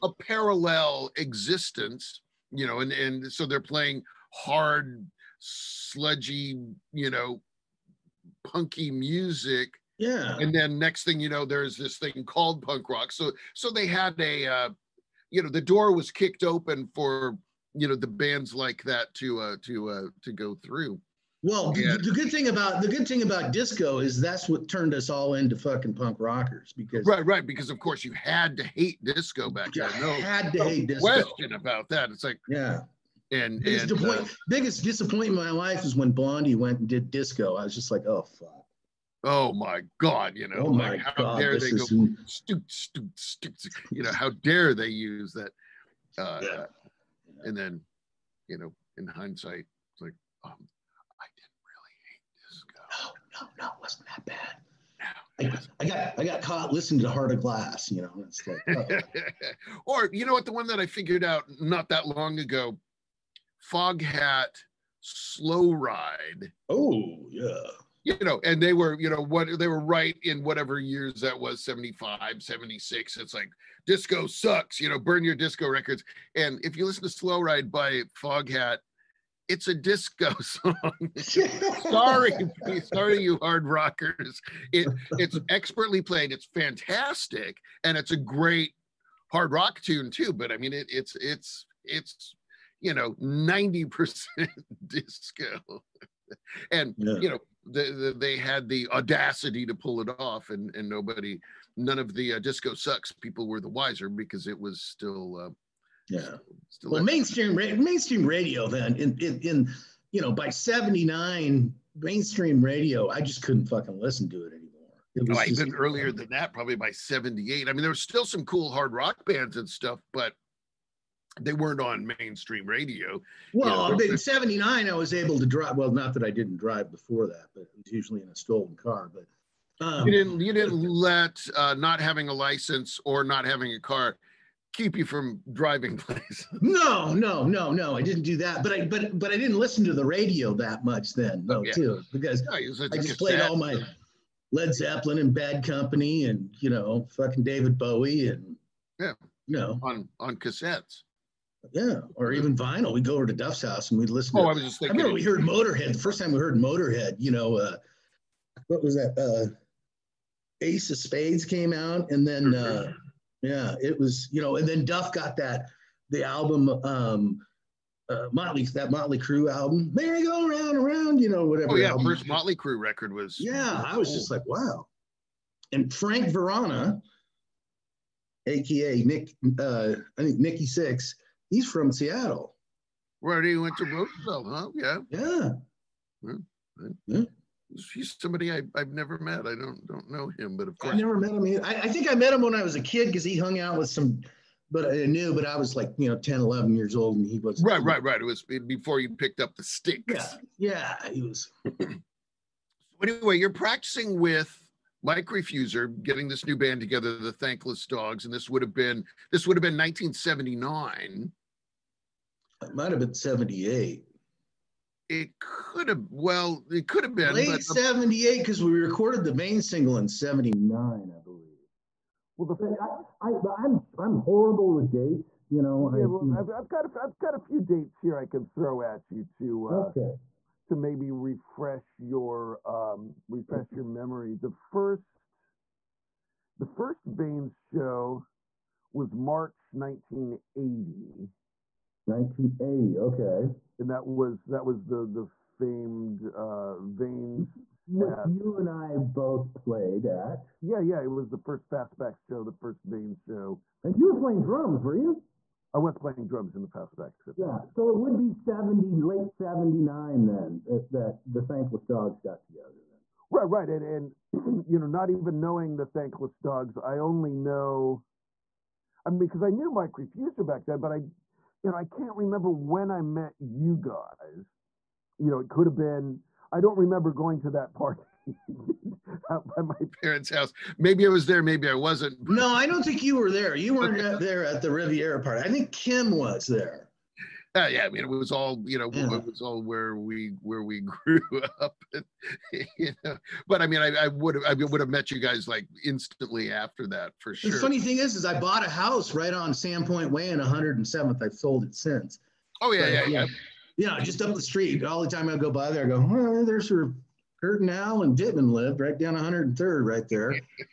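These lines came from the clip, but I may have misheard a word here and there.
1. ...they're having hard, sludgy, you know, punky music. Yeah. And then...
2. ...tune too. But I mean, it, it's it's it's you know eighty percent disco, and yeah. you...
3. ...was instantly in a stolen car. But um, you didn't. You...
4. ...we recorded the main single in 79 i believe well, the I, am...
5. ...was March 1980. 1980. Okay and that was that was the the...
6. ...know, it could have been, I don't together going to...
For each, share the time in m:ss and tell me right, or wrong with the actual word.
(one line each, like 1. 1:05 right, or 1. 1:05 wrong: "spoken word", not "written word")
1. 0:03 wrong: "playing", not "having"
2. 1:29 wrong: "ninety", not "eighty"
3. 2:07 wrong: "usually", not "instantly"
4. 3:38 right
5. 3:58 right
6. 4:35 wrong: "remember", not "together".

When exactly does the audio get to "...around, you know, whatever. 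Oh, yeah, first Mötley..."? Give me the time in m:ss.
2:50.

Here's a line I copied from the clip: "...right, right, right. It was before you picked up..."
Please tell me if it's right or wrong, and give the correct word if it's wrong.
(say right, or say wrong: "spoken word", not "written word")
right.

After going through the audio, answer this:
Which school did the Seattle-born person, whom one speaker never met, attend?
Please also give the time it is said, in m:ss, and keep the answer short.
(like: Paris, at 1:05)
Roosevelt, at 3:03.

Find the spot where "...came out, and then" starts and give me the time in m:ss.
2:41.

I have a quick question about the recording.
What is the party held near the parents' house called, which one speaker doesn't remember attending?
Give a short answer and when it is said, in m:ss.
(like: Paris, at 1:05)
Riviera, at 4:44.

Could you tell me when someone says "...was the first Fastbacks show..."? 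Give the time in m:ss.
4:11.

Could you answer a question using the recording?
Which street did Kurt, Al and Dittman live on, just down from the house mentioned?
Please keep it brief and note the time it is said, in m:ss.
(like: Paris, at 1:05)
103rd, at 5:09.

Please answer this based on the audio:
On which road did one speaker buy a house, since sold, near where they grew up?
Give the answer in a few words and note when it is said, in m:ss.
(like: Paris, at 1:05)
Sandpoint Way, at 4:59.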